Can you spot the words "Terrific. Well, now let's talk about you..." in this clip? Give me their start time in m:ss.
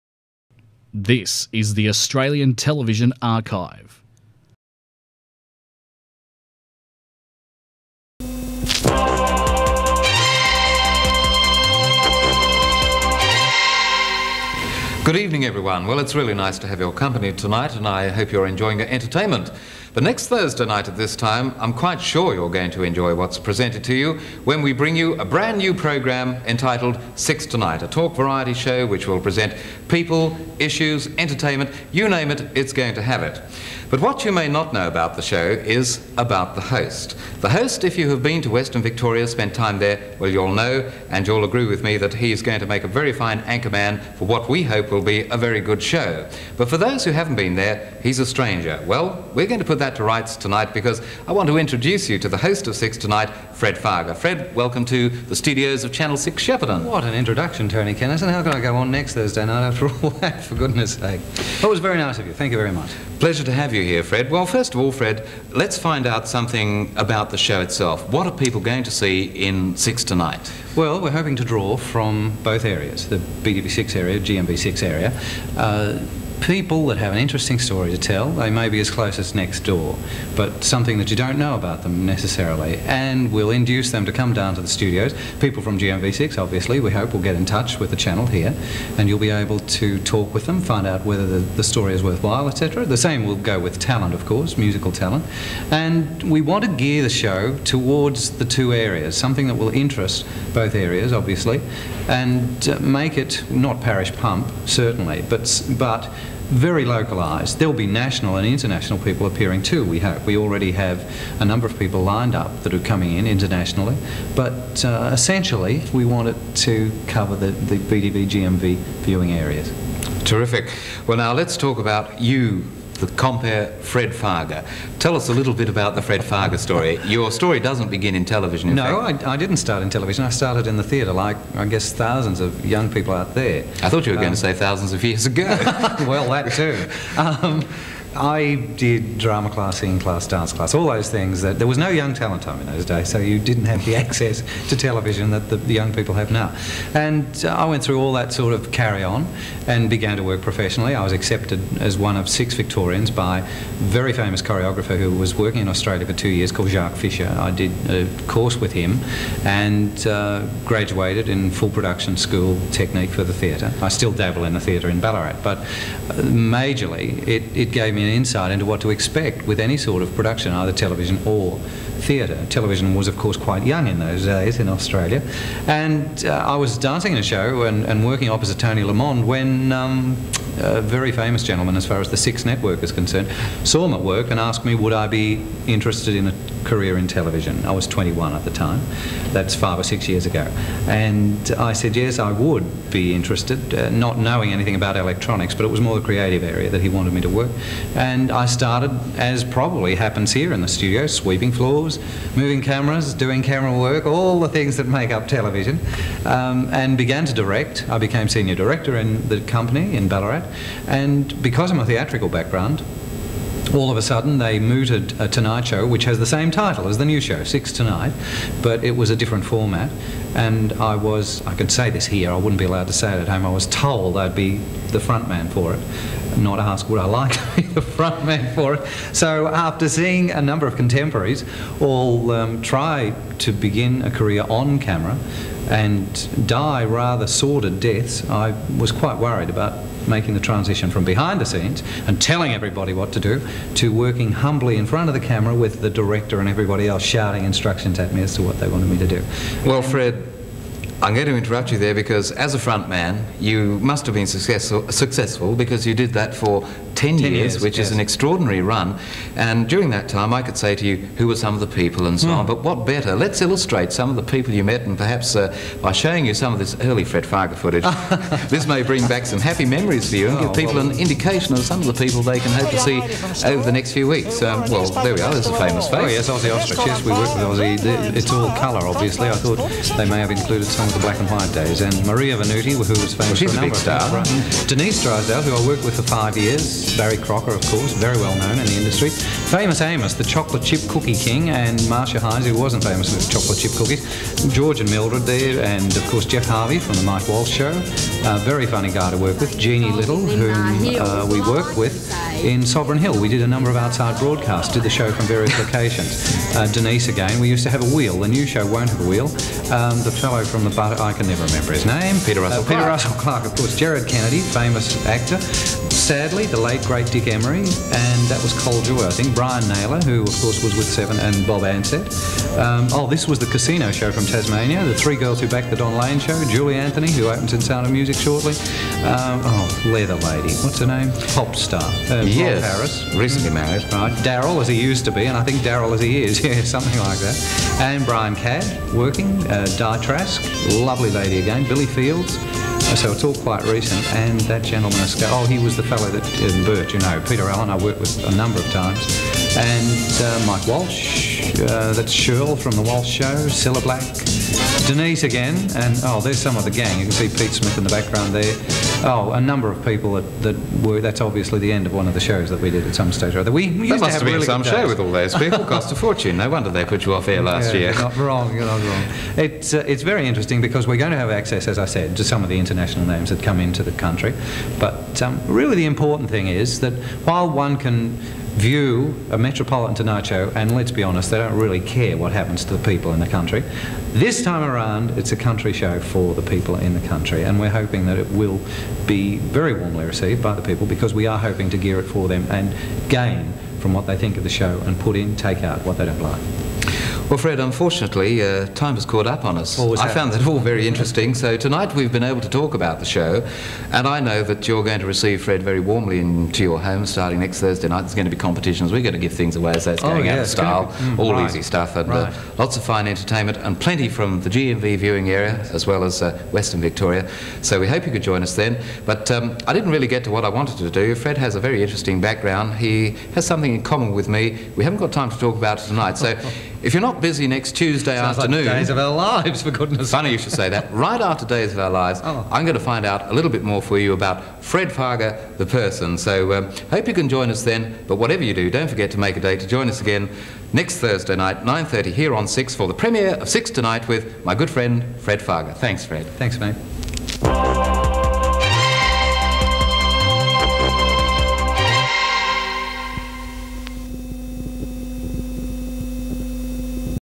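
2:00.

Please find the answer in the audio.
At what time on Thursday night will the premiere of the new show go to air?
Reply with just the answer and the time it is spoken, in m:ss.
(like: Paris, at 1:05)
9:30, at 7:21.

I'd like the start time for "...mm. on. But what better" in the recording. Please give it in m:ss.
4:22.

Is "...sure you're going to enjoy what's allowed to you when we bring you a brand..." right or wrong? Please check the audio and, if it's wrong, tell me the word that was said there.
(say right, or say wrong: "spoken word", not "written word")
wrong: "presented", not "allowed".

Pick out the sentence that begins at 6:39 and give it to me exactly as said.
I found that all very interesting.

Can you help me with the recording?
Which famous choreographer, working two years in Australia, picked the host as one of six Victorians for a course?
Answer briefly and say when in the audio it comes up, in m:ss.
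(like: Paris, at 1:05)
Jacques Fisher, at 2:36.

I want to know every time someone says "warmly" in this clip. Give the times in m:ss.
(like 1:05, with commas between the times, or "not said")
6:29, 6:45.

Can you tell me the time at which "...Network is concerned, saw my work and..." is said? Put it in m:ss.
3:02.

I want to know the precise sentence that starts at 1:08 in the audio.
What are people going to see in Six Tonight?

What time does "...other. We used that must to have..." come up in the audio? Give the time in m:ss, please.
6:03.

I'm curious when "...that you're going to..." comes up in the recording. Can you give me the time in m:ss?
6:44.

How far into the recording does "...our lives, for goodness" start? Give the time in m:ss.
7:08.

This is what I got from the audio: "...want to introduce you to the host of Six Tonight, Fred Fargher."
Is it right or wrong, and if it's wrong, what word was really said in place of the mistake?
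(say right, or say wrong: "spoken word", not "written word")
right.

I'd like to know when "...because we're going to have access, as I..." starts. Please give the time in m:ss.
6:10.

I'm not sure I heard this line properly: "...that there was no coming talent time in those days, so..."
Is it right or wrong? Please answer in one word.
wrong.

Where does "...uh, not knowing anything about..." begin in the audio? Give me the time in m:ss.
3:13.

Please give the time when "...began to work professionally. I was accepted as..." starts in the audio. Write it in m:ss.
2:29.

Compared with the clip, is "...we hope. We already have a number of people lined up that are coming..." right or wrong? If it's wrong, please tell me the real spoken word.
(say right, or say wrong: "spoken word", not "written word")
right.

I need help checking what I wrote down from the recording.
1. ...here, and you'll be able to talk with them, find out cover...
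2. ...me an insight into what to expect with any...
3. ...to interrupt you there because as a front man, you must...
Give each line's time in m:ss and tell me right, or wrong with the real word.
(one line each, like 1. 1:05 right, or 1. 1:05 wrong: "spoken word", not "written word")
1. 1:28 wrong: "whether", not "cover"
2. 2:48 right
3. 4:11 right.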